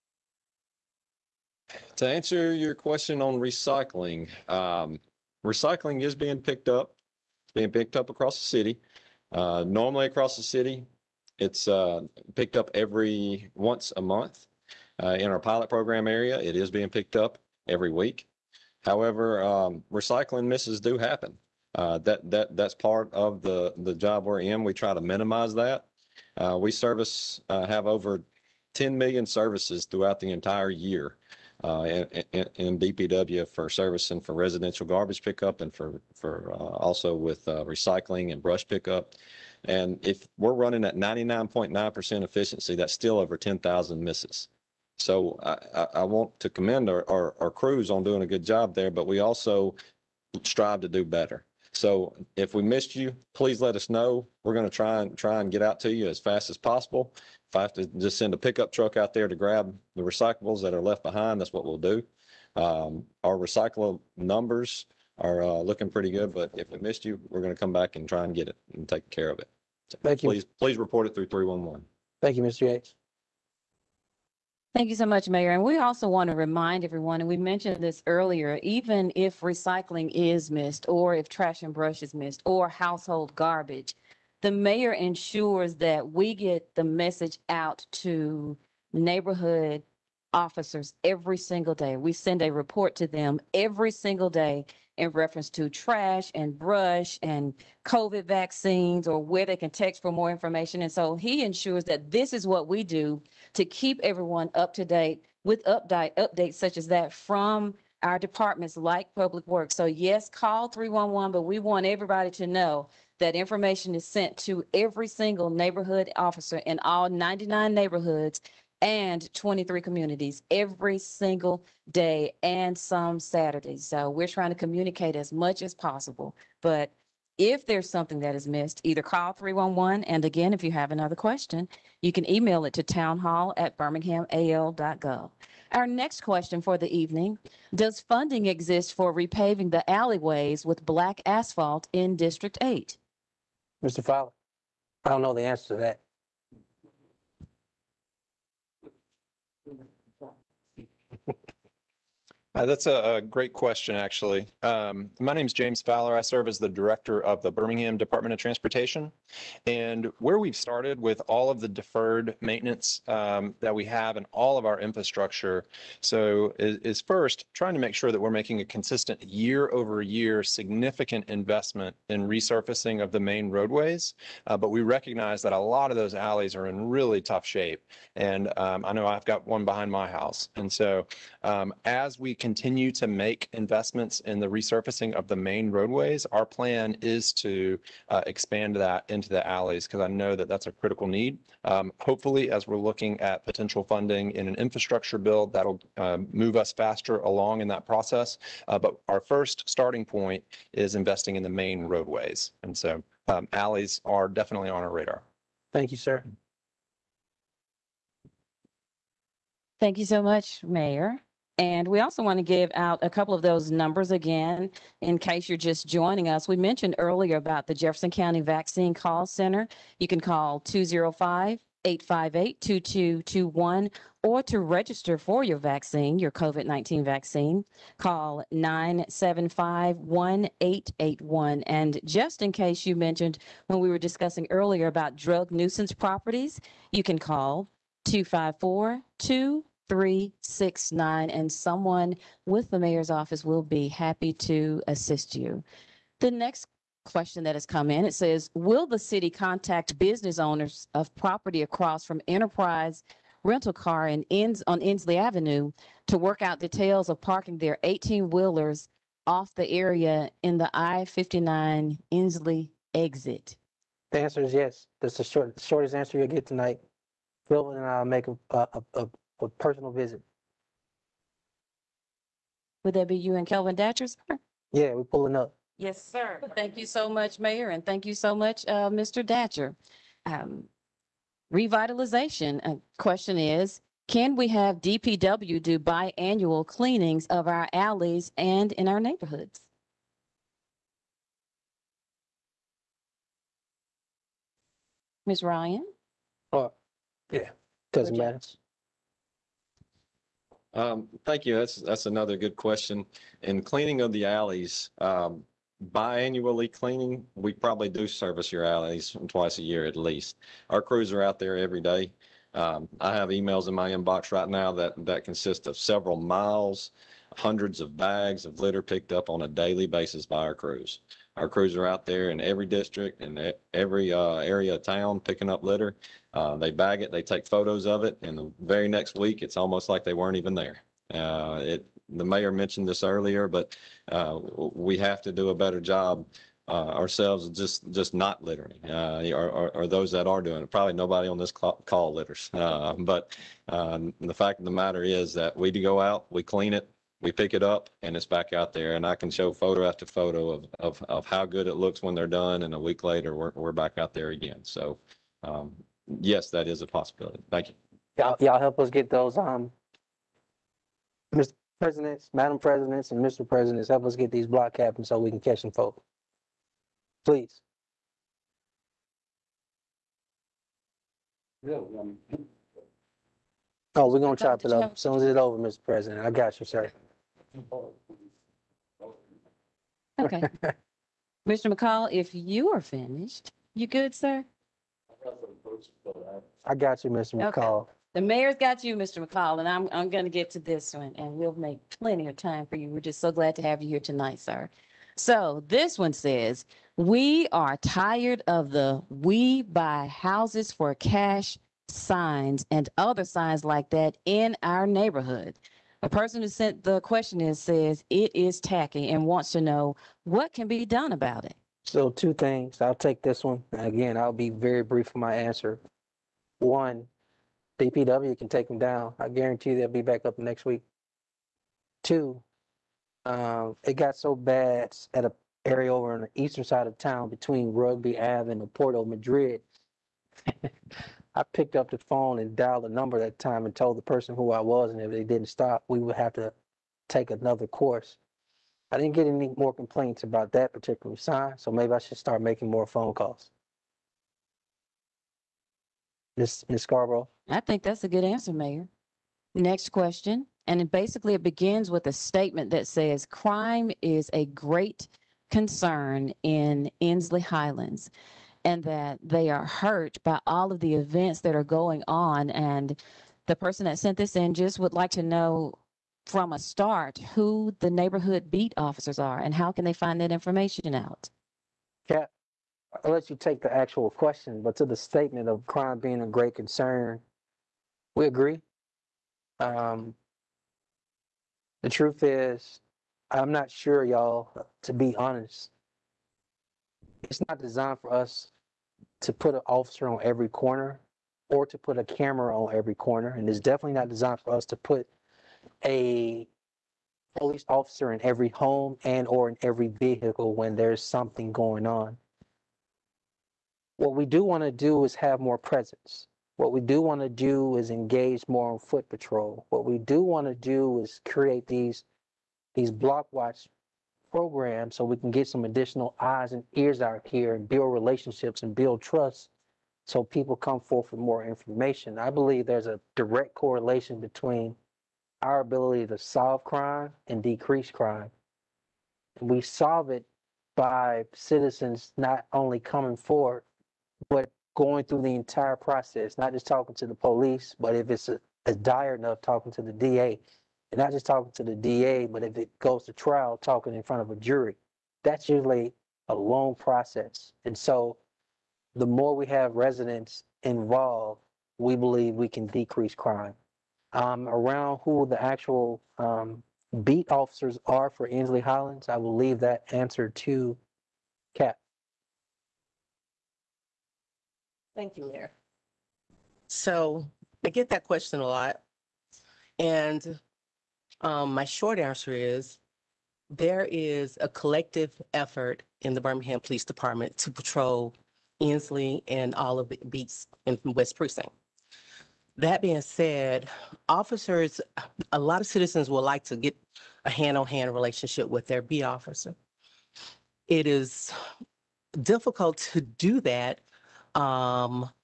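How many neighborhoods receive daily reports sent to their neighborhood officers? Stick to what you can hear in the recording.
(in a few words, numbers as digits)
99.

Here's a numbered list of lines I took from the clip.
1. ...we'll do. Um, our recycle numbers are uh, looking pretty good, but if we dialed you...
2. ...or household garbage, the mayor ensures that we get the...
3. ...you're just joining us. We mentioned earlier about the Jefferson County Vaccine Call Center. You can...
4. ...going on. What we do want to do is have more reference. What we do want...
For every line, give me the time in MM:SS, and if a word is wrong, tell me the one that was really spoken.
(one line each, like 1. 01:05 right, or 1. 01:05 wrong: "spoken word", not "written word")
1. 01:01 wrong: "missed", not "dialed"
2. 01:22 right
3. 03:35 right
4. 08:21 wrong: "presence", not "reference".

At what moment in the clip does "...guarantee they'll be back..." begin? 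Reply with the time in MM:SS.
06:59.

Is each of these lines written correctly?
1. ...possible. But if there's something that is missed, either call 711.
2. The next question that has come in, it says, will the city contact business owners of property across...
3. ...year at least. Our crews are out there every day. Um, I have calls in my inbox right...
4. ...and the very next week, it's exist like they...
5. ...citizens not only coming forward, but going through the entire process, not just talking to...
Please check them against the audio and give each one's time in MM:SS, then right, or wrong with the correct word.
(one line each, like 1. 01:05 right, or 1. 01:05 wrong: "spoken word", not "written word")
1. 02:05 wrong: "311", not "711"
2. 04:06 right
3. 05:09 wrong: "emails", not "calls"
4. 05:28 wrong: "almost", not "exist"
5. 08:51 right.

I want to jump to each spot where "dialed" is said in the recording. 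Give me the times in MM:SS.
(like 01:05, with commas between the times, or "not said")
07:12.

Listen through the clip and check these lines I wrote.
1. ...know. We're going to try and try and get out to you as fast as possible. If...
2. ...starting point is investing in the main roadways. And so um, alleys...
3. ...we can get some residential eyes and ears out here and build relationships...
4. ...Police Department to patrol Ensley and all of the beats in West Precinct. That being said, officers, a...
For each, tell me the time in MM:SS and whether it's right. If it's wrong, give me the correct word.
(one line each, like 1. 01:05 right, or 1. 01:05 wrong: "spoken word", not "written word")
1. 00:53 right
2. 03:19 right
3. 08:35 wrong: "additional", not "residential"
4. 09:36 right.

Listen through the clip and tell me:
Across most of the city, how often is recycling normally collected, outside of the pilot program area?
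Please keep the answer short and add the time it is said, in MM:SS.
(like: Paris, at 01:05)
once a month, at 00:12.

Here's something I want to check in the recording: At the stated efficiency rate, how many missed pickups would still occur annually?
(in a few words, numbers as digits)
over 10,000.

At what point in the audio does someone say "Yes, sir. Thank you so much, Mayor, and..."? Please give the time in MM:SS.
04:35.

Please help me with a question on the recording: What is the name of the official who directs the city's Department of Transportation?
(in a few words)
James Fowler.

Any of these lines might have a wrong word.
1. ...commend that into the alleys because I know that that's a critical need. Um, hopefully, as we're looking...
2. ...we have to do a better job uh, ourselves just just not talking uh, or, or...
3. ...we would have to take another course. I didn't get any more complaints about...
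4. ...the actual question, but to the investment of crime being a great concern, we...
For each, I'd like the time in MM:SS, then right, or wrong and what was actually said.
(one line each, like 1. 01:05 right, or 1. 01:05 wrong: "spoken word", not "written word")
1. 03:08 wrong: "expand", not "commend"
2. 05:34 wrong: "littering", not "talking"
3. 07:15 right
4. 07:53 wrong: "statement", not "investment".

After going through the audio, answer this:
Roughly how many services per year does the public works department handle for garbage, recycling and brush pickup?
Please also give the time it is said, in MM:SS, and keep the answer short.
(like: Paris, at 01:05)
over 10 million, at 00:27.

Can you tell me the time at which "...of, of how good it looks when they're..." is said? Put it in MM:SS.
05:50.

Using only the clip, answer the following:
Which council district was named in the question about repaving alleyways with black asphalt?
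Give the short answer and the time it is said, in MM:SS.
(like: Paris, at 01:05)
District 8, at 02:22.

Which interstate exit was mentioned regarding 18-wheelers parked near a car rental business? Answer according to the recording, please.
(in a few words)
I-59 Ensley exit.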